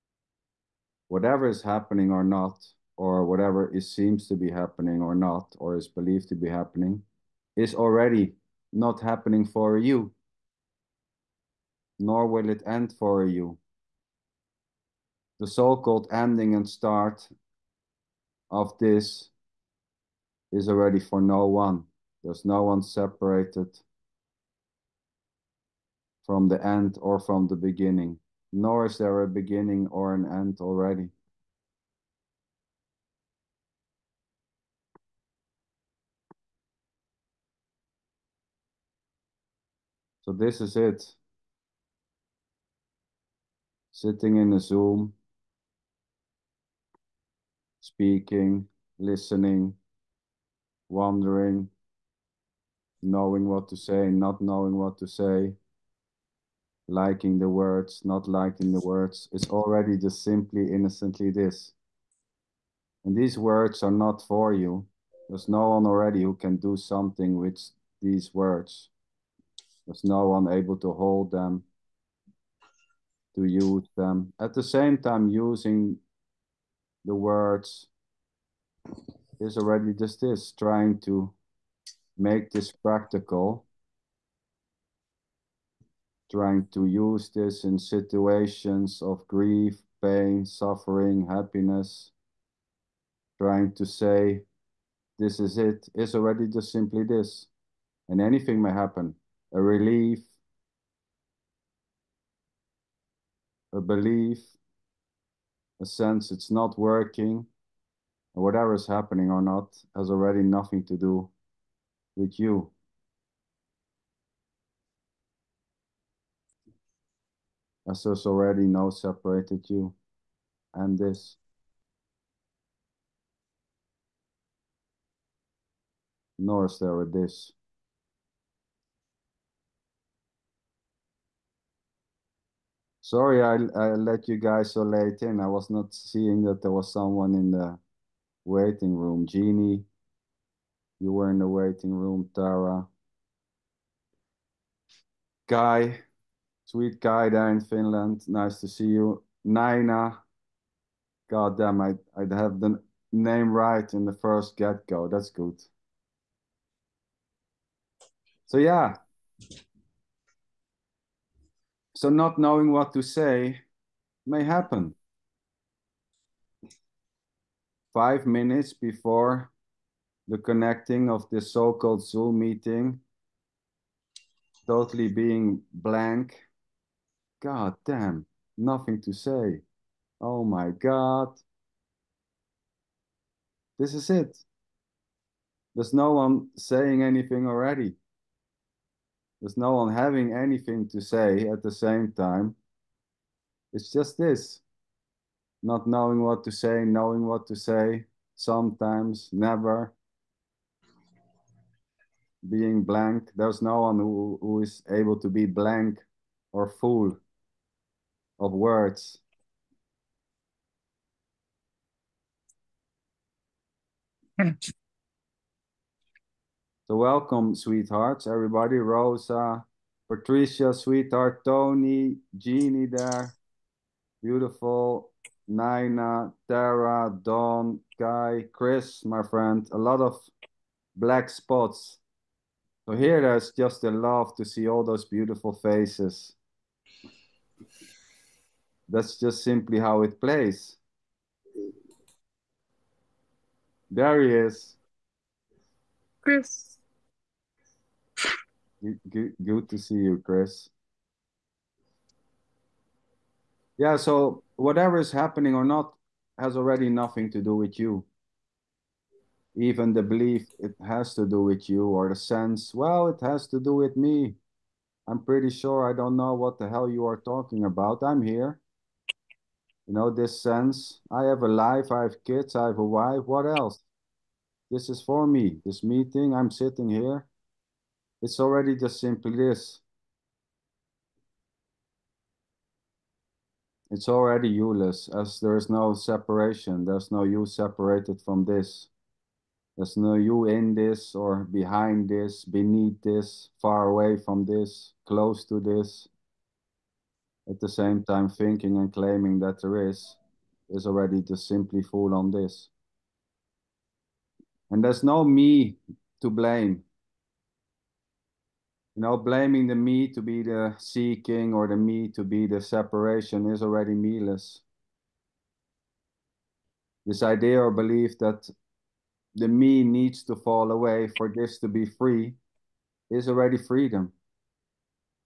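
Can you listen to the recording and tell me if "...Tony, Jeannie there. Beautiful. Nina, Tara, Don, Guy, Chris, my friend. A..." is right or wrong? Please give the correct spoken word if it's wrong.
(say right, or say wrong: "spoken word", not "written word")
right.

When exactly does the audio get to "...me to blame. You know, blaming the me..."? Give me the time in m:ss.
5:05.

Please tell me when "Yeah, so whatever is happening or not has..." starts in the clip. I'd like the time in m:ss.
4:13.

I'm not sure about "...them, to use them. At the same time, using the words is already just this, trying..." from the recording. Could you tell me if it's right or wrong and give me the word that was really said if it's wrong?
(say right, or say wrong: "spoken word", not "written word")
right.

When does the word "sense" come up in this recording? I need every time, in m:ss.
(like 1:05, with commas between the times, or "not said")
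1:45, 4:22, 4:30.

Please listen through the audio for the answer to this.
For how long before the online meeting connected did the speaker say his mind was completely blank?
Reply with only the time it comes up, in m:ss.
2:47.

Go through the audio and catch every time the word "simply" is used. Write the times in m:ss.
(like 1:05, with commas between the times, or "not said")
1:00, 1:36, 3:59, 4:38, 5:01.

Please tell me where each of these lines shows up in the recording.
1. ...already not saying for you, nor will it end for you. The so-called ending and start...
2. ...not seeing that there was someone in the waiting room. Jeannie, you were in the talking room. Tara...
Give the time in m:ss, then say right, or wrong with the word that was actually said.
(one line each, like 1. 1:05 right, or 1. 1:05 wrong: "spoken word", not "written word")
1. 0:07 wrong: "happening", not "saying"
2. 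2:15 wrong: "waiting", not "talking".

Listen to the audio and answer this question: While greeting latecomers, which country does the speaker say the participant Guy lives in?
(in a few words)
Finland.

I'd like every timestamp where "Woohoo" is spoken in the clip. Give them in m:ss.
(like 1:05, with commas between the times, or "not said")
not said.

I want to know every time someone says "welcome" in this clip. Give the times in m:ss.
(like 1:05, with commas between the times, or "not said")
3:36.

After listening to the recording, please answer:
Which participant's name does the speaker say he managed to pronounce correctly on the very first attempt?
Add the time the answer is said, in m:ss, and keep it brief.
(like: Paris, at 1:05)
Naina, at 2:29.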